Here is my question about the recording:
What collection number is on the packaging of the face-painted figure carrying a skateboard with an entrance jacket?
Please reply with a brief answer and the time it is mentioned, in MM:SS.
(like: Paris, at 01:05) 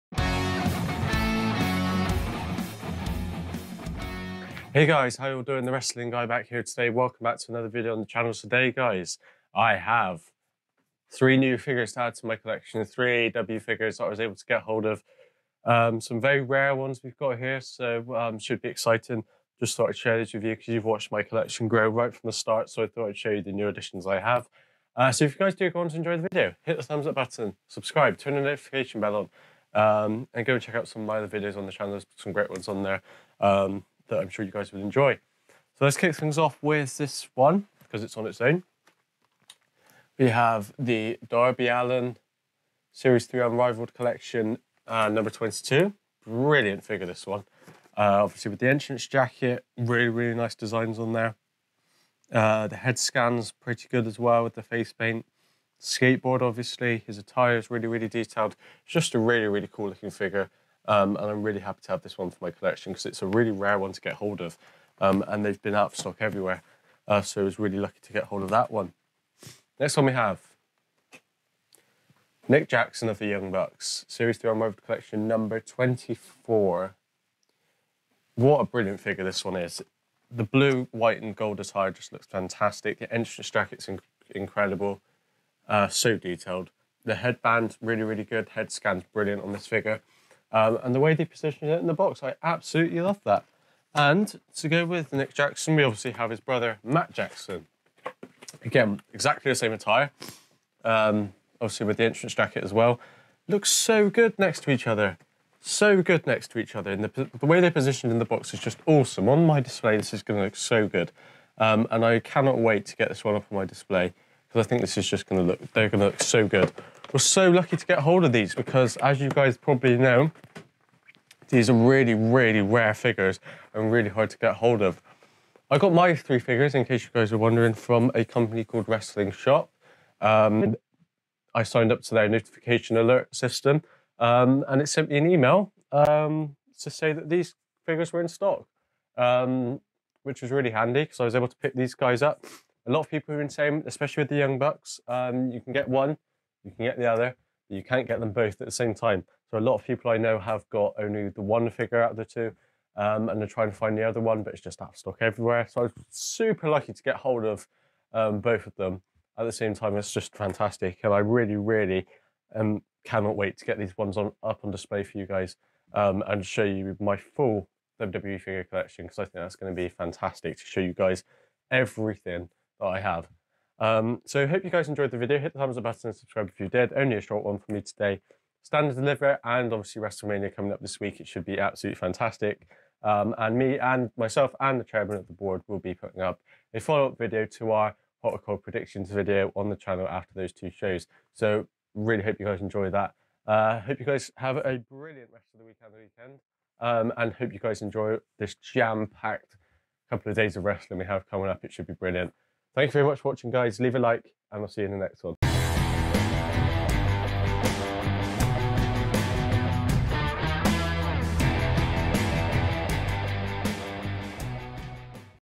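22, at 00:45.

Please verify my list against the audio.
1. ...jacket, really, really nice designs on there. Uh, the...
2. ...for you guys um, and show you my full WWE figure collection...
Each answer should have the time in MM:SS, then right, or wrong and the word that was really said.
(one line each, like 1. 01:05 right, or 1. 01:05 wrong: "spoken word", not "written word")
1. 00:49 right
2. 02:45 right.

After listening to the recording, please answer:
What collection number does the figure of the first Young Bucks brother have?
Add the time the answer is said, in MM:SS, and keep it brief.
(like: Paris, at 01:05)
24, at 01:15.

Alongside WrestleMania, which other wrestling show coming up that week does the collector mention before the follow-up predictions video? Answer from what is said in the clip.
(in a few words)
Stand and Deliver.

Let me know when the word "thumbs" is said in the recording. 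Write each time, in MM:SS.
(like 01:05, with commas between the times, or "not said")
00:26, 02:55.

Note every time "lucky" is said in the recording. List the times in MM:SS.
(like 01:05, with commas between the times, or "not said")
01:07, 01:57, 02:36.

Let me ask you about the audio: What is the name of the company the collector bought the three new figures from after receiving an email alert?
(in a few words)
Wrestling Shop.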